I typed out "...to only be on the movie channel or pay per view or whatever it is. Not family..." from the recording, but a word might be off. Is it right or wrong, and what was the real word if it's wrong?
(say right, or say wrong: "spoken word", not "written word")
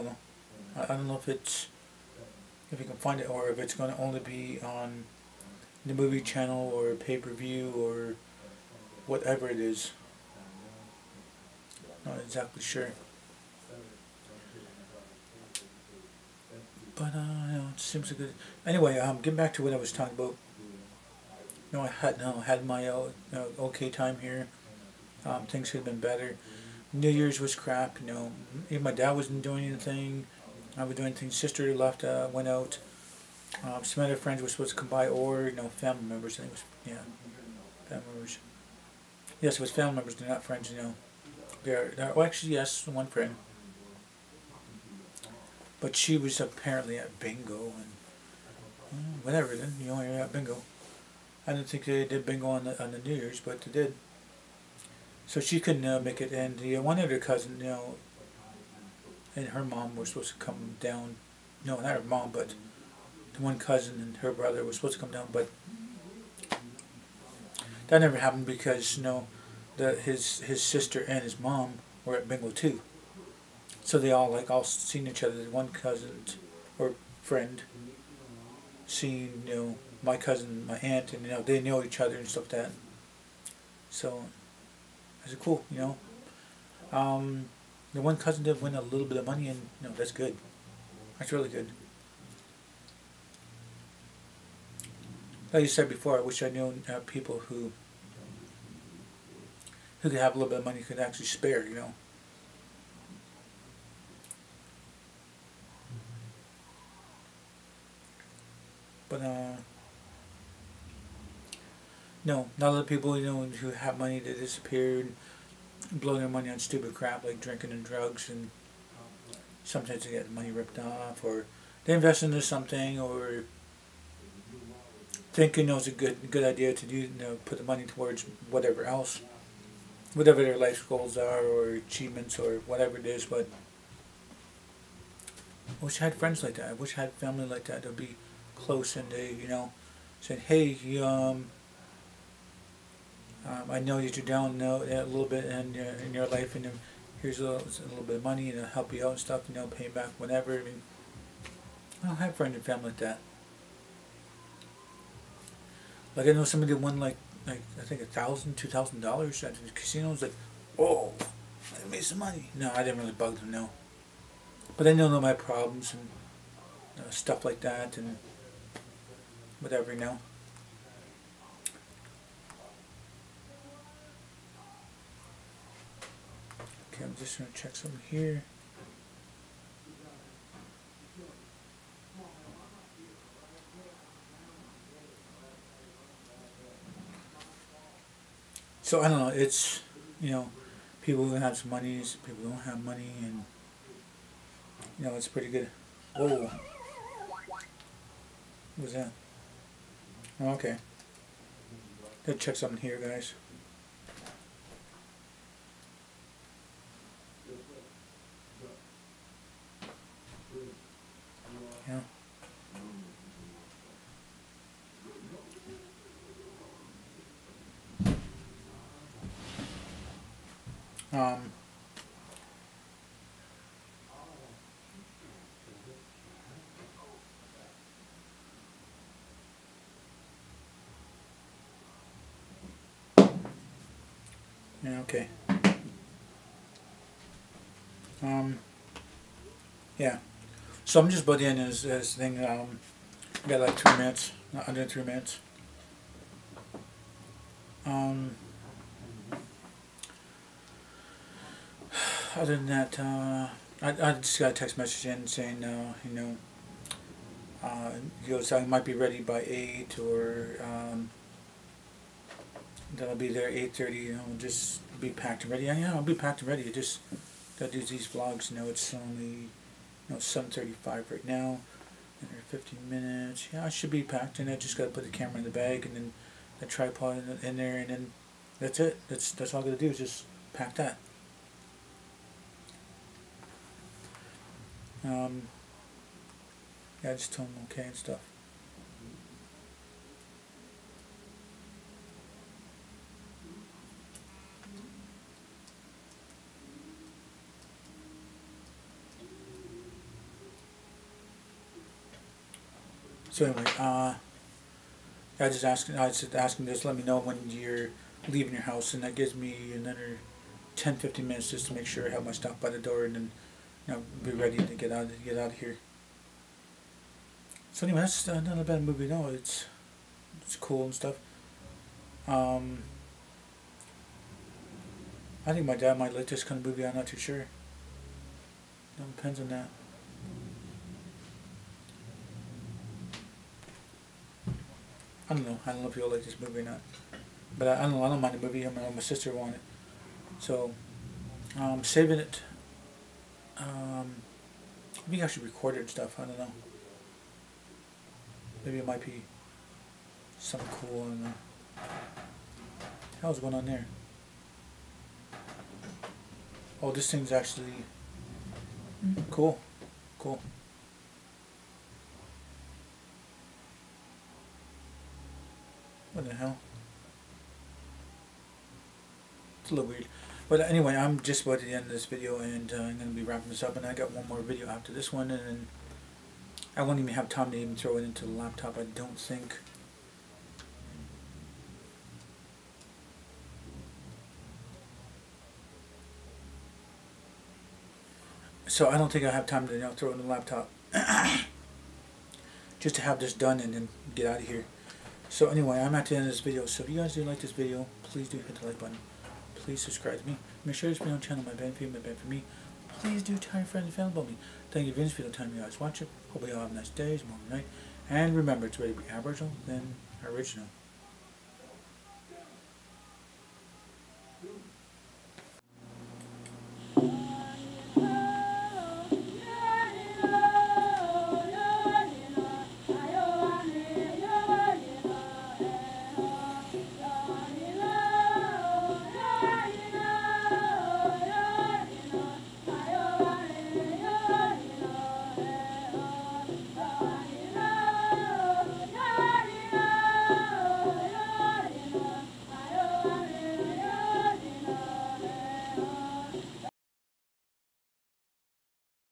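wrong: "exactly", not "family".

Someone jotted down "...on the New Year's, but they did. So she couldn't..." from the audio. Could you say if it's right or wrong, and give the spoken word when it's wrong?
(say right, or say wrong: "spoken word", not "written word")
right.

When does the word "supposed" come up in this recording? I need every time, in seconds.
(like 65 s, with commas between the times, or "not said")
34 s, 60 s, 64 s.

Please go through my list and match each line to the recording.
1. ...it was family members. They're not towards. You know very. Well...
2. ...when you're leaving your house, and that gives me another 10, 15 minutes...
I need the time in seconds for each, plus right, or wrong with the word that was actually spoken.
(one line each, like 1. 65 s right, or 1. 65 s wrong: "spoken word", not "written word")
1. 39 s wrong: "friends", not "towards"
2. 307 s right.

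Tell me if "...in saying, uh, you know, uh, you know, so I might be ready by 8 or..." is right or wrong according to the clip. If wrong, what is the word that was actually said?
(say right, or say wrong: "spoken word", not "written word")
right.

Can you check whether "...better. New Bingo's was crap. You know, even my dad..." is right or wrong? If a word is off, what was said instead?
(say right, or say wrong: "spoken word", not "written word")
wrong: "Year", not "Bingo".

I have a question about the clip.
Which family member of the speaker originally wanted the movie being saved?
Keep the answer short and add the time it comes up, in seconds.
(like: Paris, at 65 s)
His sister, at 338 s.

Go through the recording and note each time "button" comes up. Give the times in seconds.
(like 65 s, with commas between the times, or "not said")
398 s.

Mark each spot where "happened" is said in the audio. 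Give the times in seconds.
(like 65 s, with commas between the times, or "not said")
68 s.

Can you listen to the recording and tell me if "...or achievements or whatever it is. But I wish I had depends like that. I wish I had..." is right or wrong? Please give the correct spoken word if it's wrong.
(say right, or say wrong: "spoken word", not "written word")
wrong: "friends", not "depends".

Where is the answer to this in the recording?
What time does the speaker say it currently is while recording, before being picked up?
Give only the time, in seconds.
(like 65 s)
270 s.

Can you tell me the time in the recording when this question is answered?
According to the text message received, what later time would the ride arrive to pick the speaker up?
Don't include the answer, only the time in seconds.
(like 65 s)
263 s.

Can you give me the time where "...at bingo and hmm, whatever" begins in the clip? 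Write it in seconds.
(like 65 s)
46 s.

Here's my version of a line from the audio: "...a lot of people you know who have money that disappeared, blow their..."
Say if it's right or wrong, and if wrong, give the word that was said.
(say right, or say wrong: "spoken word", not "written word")
right.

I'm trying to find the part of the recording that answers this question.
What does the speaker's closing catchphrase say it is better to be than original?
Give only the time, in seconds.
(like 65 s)
409 s.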